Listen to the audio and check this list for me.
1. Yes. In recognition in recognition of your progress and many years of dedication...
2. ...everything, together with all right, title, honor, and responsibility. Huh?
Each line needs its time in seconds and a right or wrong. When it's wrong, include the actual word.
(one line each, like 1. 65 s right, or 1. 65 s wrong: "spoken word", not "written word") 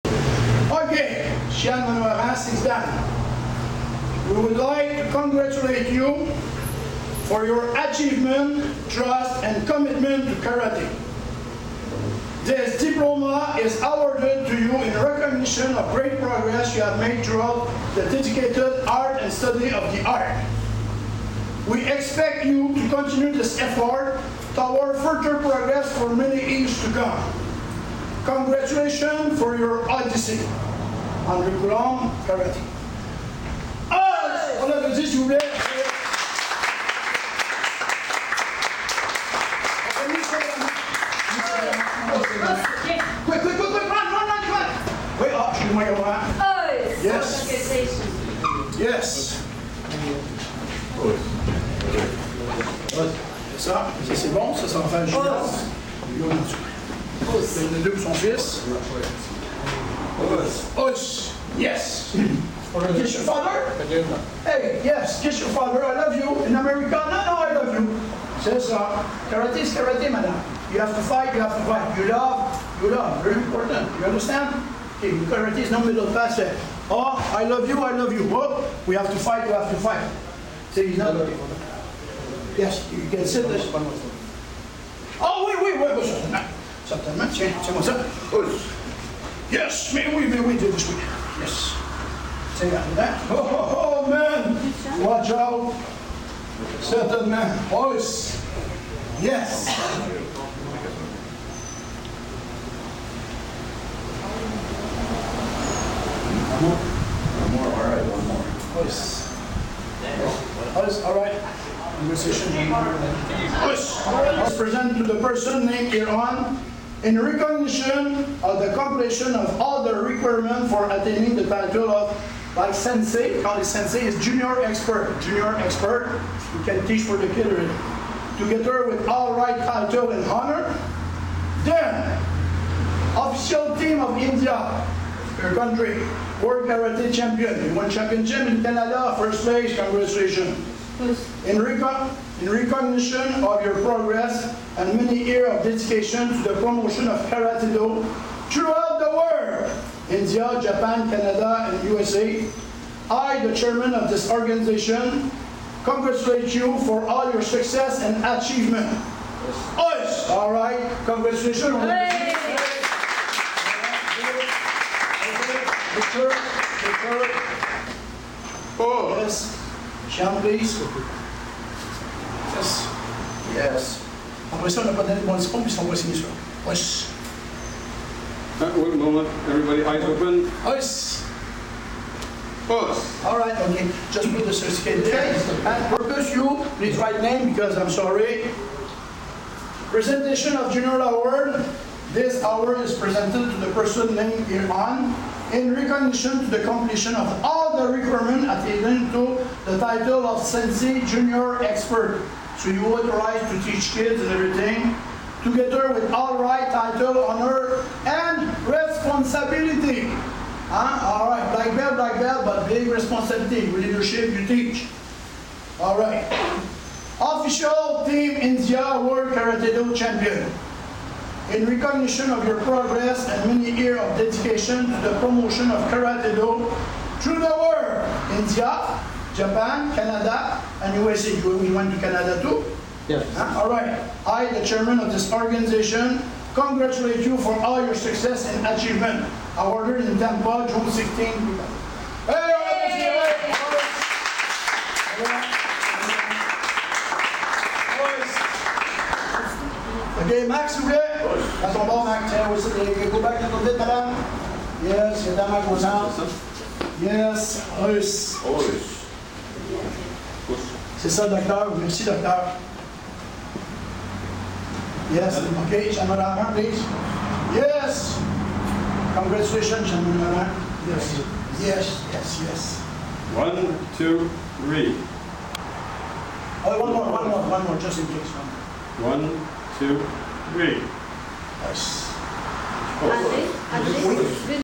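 1. 140 s right
2. 204 s right.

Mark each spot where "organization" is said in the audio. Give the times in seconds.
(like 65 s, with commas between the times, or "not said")
154 s, 235 s.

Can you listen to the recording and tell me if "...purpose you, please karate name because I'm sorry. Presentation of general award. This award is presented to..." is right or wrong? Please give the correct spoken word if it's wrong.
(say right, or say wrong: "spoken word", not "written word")
wrong: "write", not "karate".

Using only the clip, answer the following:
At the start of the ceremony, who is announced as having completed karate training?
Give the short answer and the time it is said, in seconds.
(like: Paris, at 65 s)
Shannon Maras, at 1 s.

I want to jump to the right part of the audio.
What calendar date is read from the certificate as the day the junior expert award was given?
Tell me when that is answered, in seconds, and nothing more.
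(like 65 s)
240 s.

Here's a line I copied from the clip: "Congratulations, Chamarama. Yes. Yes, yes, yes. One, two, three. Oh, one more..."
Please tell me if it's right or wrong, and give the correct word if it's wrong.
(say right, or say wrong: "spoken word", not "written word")
right.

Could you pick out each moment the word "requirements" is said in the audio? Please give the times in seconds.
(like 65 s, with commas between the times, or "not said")
120 s, 197 s.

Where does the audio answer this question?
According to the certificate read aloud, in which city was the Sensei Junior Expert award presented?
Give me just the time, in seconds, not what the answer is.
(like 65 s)
240 s.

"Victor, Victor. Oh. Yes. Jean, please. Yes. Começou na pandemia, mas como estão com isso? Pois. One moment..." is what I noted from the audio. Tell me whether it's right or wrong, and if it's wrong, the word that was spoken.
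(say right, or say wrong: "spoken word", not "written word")
right.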